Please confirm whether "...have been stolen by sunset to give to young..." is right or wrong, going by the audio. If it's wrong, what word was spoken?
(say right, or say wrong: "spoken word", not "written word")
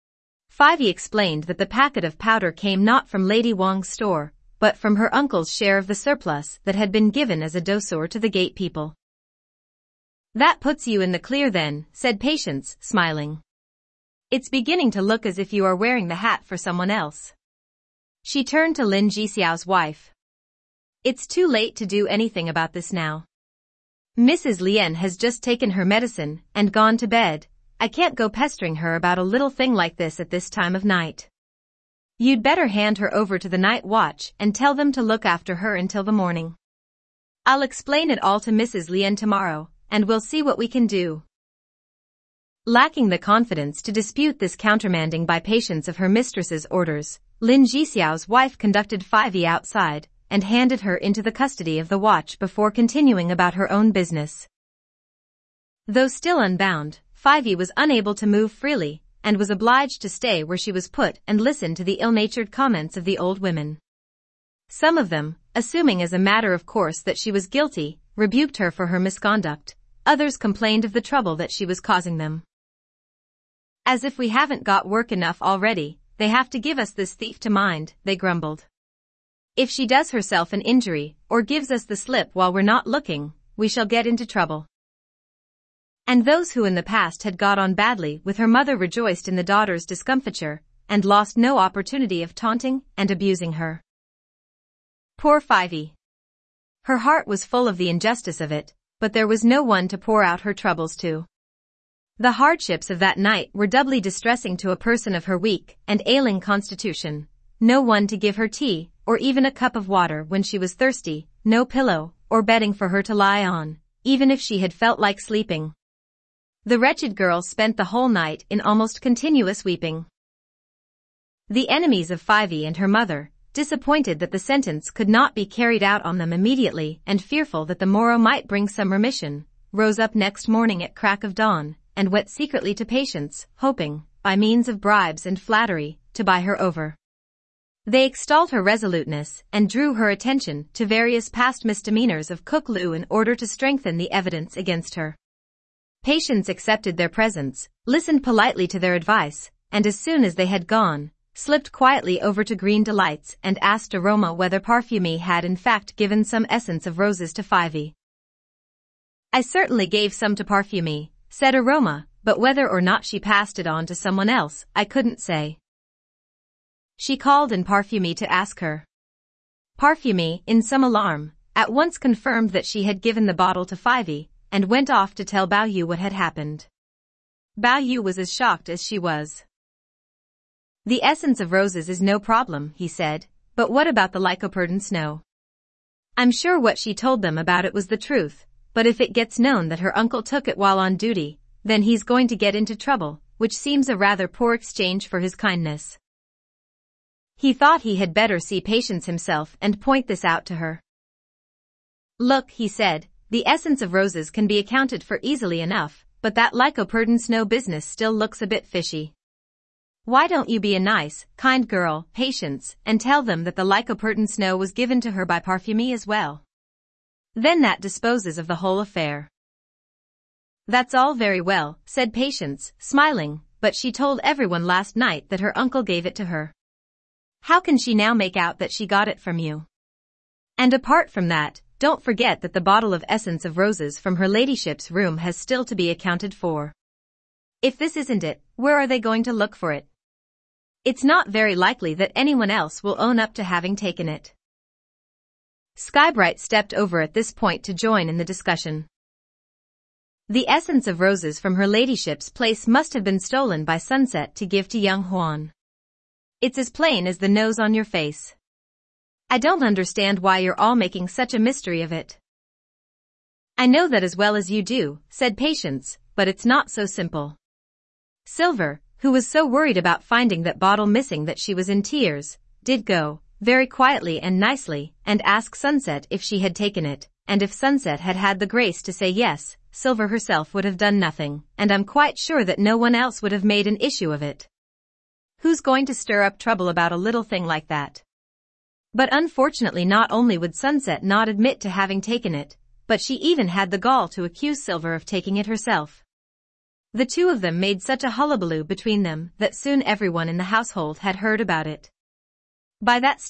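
right.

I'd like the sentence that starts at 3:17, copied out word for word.
He thought he had better see Patience himself and point this out to her.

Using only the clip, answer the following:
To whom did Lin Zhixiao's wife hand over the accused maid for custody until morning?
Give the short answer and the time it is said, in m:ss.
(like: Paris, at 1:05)
the night watch, at 0:51.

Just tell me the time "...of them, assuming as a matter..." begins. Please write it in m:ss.
1:04.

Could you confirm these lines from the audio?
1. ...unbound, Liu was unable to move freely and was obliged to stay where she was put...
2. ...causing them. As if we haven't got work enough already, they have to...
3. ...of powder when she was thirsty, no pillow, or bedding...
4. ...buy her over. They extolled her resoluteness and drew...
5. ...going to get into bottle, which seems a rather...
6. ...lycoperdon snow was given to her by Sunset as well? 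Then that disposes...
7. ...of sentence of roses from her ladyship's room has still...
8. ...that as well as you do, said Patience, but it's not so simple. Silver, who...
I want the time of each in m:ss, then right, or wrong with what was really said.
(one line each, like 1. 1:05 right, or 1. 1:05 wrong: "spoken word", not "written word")
1. 0:56 wrong: "Fivey", not "Liu"
2. 1:11 right
3. 1:49 wrong: "water", not "powder"
4. 2:16 right
5. 3:12 wrong: "trouble", not "bottle"
6. 3:33 wrong: "Parfumée", not "Sunset"
7. 3:52 wrong: "essence", not "sentence"
8. 4:23 right.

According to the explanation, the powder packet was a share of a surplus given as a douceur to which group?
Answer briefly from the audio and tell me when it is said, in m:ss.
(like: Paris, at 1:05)
the gate people, at 0:08.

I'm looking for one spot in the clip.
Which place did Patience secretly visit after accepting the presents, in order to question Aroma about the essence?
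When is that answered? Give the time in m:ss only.
2:32.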